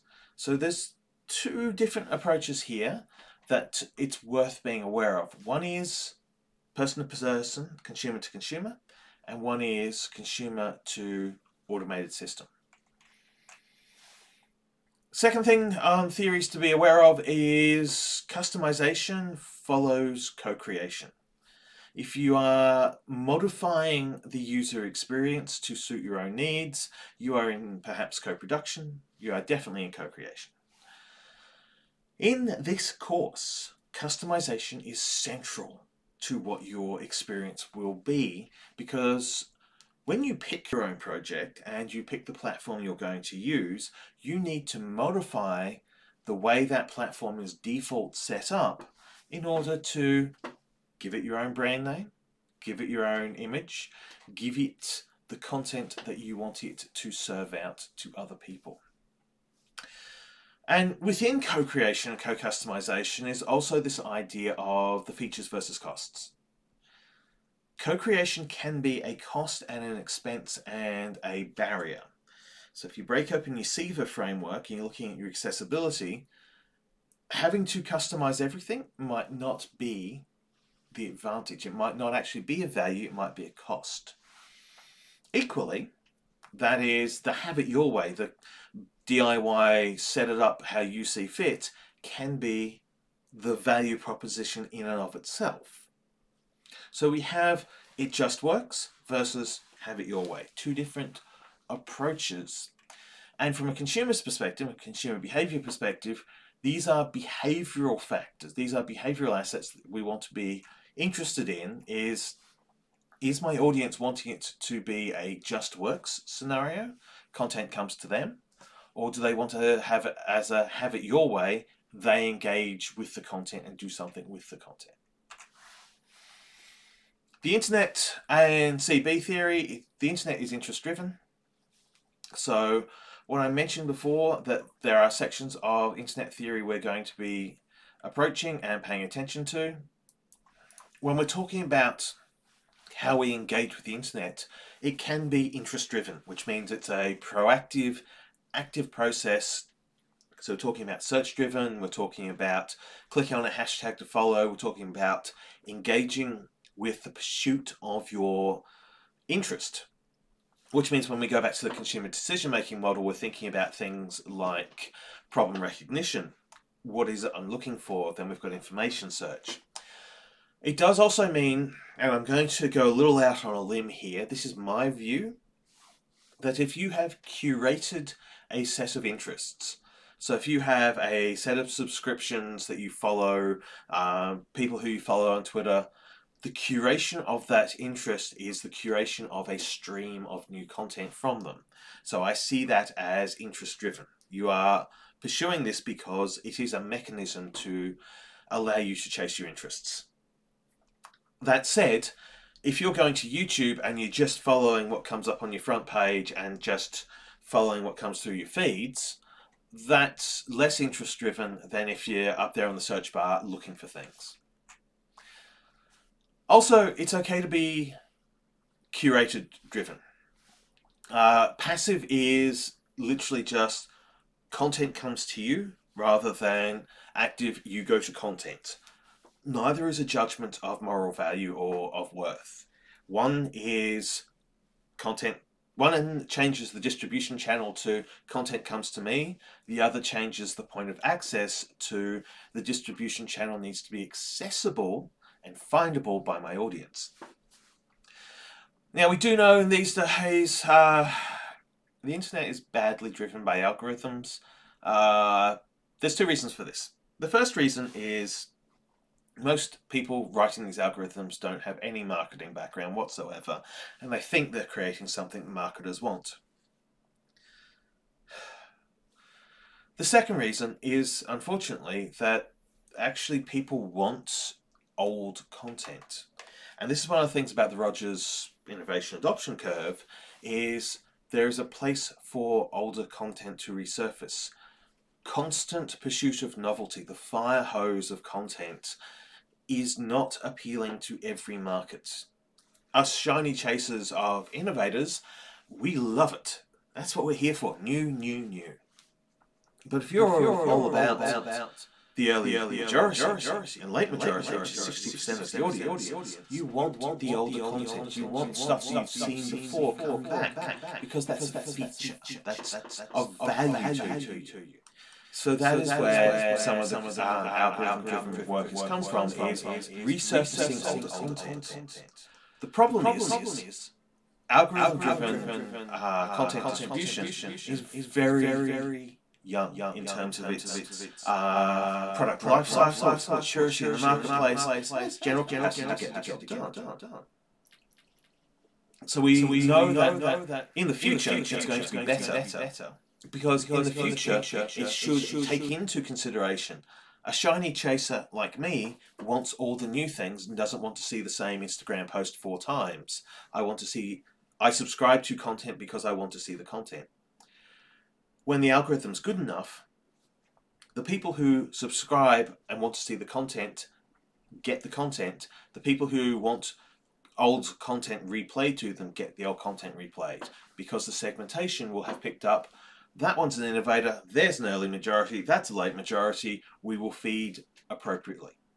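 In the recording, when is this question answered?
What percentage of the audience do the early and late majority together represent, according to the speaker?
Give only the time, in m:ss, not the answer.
5:04.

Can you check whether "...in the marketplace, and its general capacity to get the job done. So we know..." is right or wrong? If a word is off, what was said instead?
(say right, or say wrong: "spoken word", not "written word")
right.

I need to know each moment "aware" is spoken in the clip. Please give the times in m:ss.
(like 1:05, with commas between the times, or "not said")
0:04, 0:16.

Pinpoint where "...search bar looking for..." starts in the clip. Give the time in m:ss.
3:32.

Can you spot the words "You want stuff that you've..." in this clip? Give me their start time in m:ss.
5:08.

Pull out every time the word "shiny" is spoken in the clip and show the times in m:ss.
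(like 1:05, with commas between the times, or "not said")
4:53, 5:47.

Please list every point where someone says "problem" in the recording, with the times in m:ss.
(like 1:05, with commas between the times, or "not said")
2:45, 5:22.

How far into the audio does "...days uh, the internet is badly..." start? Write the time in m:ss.
4:09.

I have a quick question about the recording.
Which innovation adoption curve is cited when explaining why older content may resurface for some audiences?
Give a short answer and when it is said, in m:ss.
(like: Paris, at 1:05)
Rogers, at 4:37.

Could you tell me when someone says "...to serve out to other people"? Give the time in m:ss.
0:56.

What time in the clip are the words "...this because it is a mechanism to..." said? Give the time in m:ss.
3:15.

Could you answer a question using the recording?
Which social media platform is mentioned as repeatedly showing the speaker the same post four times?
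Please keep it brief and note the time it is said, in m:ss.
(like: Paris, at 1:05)
Instagram, at 5:51.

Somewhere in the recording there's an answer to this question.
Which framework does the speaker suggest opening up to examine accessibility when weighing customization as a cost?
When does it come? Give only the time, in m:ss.
1:13.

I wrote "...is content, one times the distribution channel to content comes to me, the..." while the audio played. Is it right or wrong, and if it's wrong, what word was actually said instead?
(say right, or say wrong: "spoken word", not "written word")
wrong: "changes", not "times".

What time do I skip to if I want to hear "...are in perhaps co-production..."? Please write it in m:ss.
0:27.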